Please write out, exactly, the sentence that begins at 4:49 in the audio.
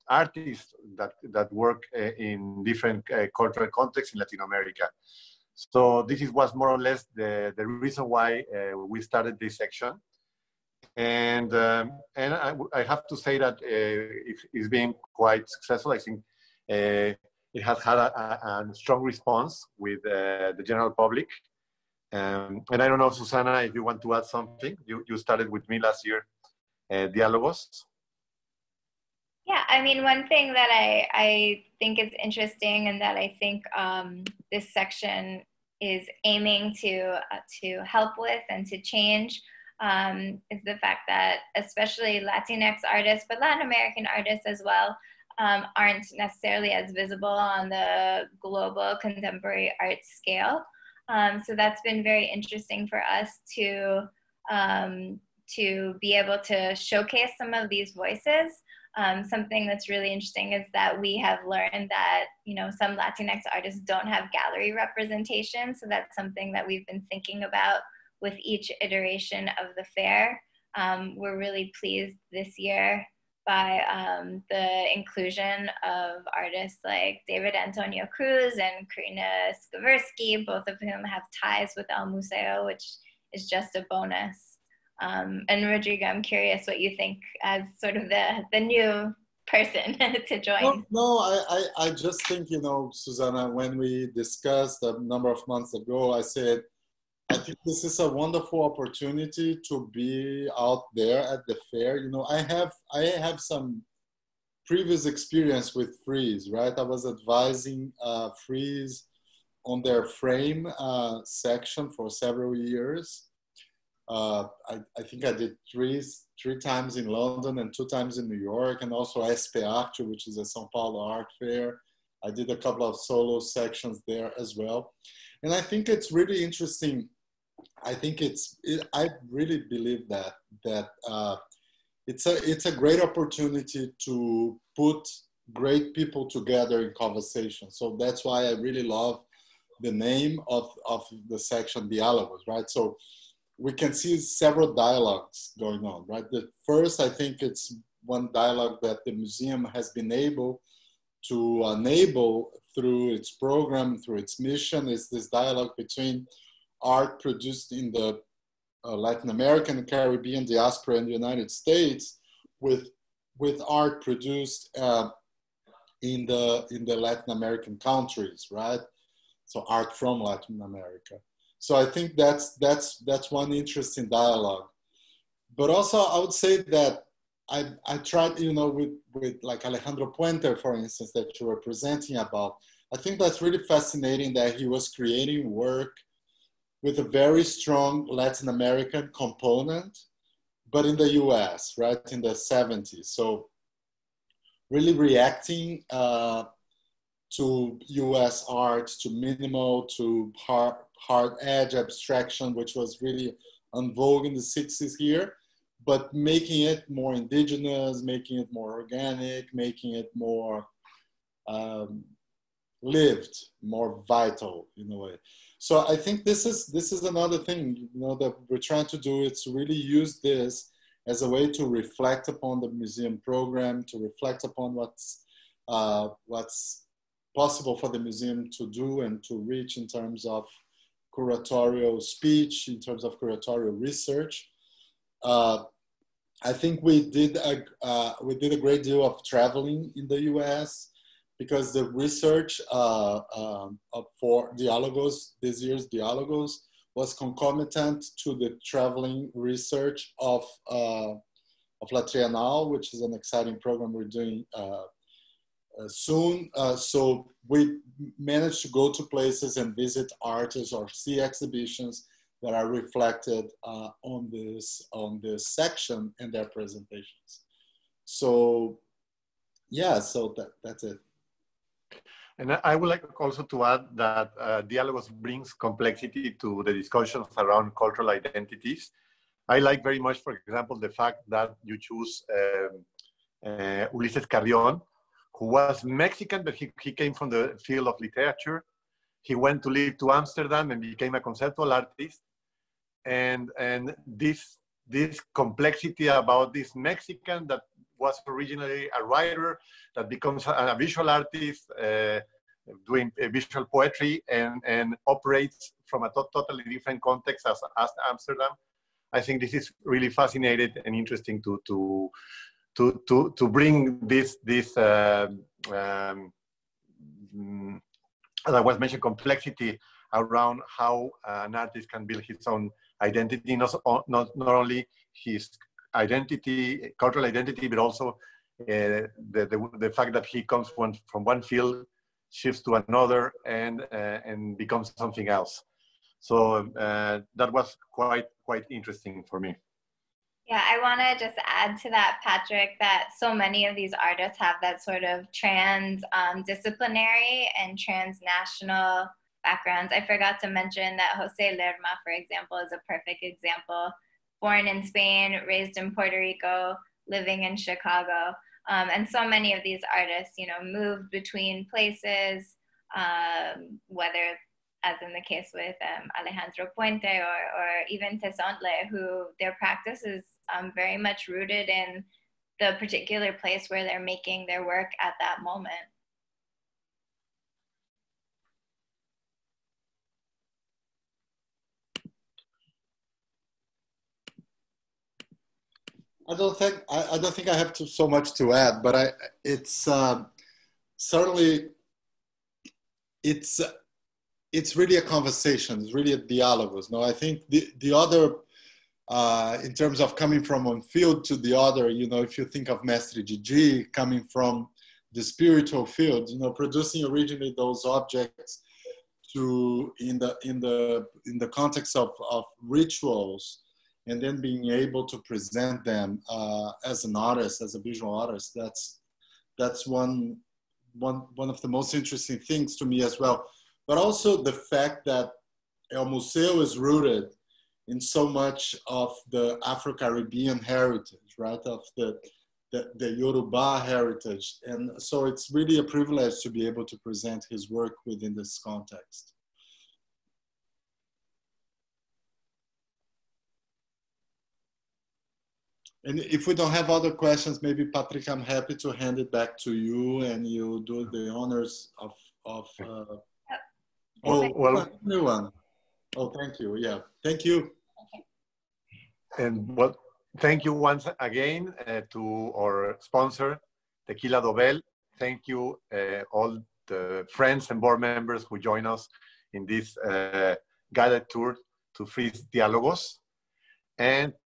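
He went to live to Amsterdam and became a conceptual artist.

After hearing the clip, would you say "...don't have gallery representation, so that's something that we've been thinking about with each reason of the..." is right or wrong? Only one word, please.
wrong.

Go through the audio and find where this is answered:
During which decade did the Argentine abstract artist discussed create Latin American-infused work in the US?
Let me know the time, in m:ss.
3:12.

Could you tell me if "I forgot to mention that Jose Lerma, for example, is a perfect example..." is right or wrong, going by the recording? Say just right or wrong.
right.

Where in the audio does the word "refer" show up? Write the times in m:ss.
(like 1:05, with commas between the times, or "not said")
not said.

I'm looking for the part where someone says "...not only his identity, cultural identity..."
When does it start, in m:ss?
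5:24.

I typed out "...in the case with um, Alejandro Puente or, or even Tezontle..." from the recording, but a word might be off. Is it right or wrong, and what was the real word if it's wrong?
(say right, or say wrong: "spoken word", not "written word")
right.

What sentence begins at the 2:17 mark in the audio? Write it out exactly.
So that's why I really love the name of of the section dialogues, right?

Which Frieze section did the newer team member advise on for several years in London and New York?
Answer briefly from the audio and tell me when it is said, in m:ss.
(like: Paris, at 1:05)
Frame, at 1:50.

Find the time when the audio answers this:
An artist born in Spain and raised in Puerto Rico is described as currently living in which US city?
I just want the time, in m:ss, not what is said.
5:57.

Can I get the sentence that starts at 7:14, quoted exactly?
And so it's really a privilege to be able to present his work within this context.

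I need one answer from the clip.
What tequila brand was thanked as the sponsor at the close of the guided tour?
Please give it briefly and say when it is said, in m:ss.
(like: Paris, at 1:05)
Tequila Dobel, at 7:44.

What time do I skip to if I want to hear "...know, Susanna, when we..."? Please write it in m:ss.
1:32.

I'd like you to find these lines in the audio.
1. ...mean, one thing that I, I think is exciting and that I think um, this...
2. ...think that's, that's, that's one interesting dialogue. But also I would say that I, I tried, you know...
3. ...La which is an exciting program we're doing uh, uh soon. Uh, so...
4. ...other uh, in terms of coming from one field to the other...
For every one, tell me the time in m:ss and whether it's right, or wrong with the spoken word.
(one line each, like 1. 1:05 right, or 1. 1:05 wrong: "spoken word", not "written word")
1. 0:29 wrong: "interesting", not "exciting"
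2. 2:51 right
3. 4:11 right
4. 6:37 right.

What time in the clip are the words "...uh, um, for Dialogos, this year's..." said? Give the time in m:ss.
4:02.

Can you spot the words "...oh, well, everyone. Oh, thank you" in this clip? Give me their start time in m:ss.
7:34.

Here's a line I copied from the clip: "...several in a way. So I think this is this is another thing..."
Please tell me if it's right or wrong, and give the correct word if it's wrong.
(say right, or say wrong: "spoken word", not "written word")
wrong: "vital", not "several".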